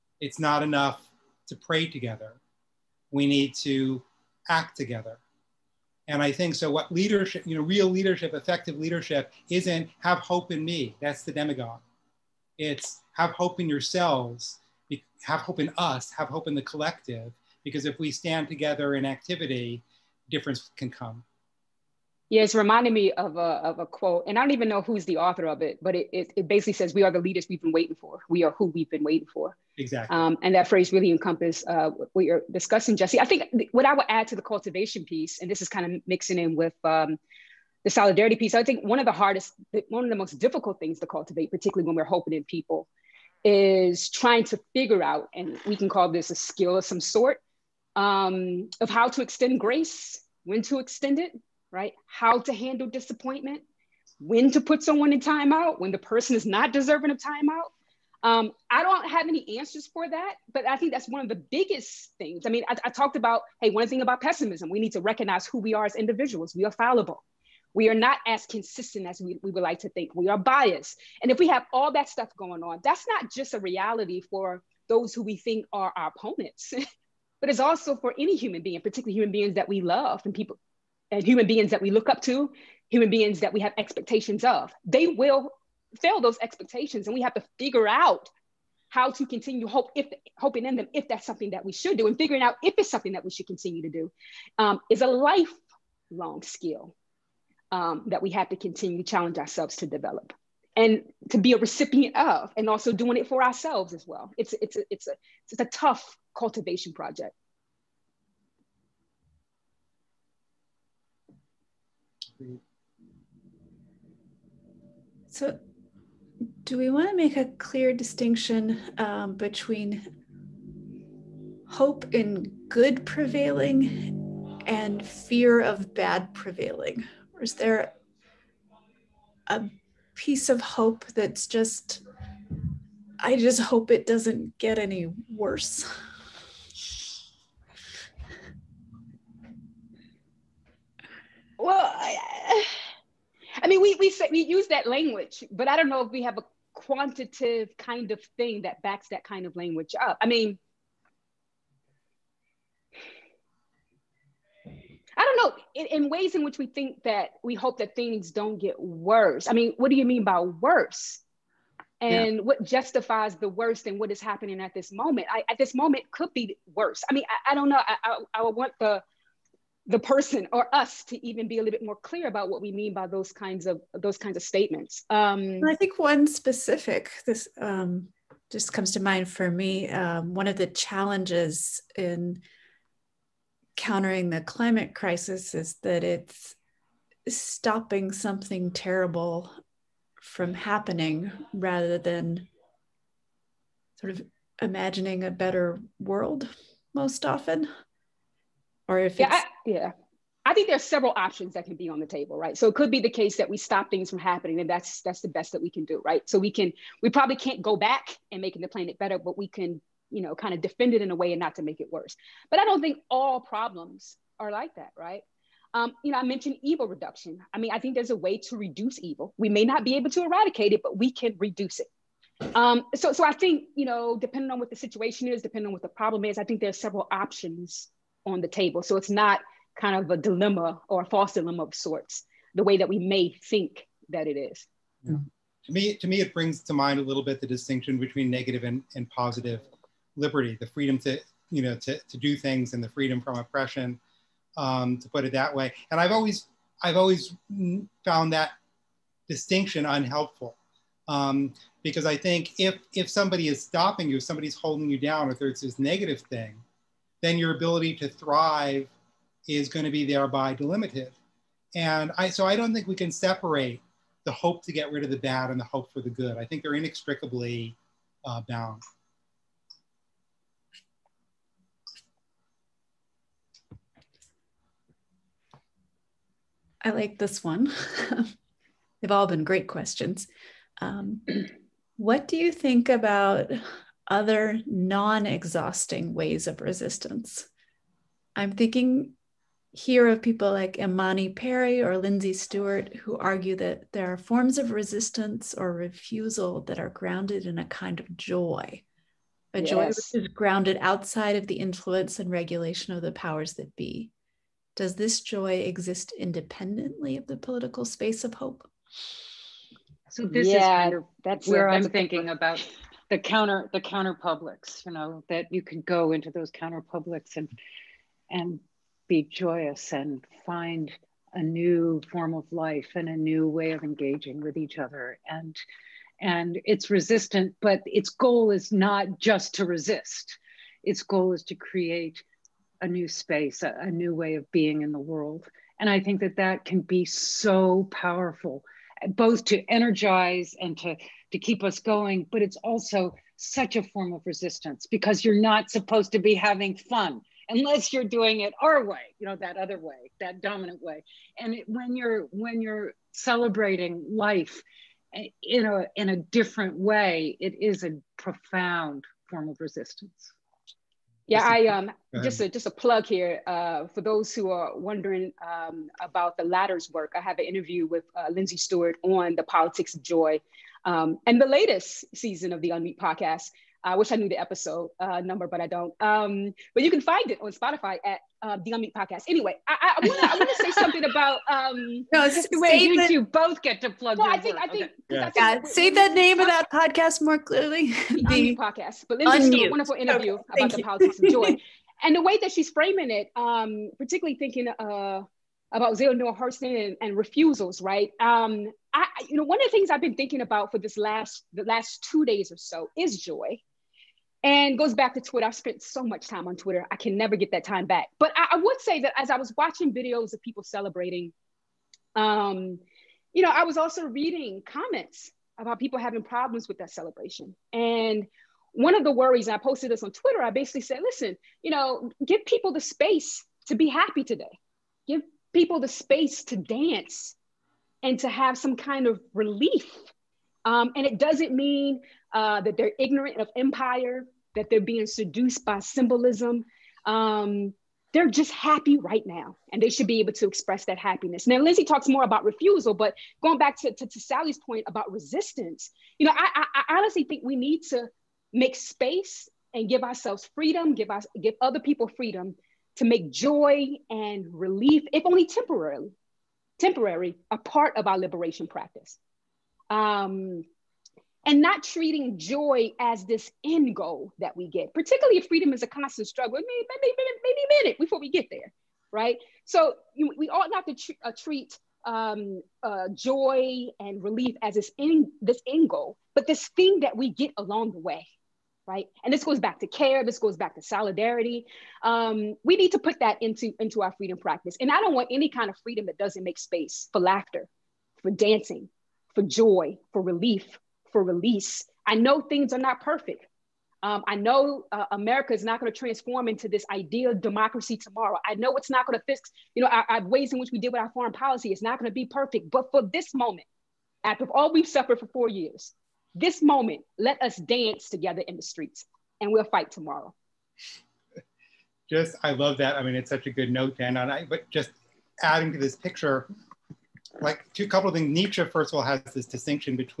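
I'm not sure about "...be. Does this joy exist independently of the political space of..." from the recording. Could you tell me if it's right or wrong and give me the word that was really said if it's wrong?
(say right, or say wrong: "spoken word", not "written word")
right.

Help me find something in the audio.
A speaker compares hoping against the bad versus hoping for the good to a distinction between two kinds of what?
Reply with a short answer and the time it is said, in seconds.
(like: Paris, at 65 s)
liberty, at 240 s.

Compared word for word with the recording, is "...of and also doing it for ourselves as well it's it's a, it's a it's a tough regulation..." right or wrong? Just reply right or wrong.
wrong.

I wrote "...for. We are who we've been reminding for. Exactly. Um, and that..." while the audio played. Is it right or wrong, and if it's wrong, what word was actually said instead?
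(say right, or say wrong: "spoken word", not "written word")
wrong: "waiting", not "reminding".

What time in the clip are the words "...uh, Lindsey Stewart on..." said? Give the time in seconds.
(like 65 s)
368 s.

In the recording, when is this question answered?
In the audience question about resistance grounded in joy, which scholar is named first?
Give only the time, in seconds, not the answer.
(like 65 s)
290 s.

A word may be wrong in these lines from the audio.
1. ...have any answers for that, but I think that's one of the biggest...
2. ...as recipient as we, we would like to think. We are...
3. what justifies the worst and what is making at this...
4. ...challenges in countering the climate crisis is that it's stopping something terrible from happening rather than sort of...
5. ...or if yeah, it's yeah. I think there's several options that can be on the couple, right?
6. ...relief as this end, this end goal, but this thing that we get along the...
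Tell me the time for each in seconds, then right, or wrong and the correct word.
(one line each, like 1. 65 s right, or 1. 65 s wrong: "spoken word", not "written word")
1. 59 s right
2. 68 s wrong: "consistent", not "recipient"
3. 162 s wrong: "happening", not "making"
4. 180 s right
5. 198 s wrong: "table", not "couple"
6. 474 s right.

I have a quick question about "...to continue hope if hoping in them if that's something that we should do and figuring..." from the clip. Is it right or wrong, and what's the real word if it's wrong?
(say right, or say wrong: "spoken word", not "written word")
right.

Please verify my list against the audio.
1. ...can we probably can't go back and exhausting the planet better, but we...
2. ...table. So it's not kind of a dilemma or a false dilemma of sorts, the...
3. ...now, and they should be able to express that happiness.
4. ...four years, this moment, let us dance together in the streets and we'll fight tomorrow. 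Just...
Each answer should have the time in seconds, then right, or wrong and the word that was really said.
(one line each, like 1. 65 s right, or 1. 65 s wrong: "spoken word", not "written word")
1. 206 s wrong: "making", not "exhausting"
2. 228 s right
3. 439 s right
4. 505 s right.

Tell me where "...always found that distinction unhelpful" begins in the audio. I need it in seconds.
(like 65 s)
246 s.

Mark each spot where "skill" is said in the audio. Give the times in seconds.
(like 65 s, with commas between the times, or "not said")
46 s, 96 s.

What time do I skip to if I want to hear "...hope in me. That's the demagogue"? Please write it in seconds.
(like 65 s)
10 s.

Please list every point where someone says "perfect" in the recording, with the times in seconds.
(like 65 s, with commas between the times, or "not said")
493 s, 502 s.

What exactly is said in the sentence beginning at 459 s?
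Um, and not treating joy as this end goal that we get, particularly if freedom is a constant struggle.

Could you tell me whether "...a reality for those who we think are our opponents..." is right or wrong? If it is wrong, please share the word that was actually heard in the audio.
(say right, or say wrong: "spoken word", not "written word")
right.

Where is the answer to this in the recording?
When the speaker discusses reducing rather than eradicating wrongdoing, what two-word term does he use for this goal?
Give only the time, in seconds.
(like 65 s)
216 s.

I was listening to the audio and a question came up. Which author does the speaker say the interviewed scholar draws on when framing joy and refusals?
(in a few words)
Zora Neale Hurston.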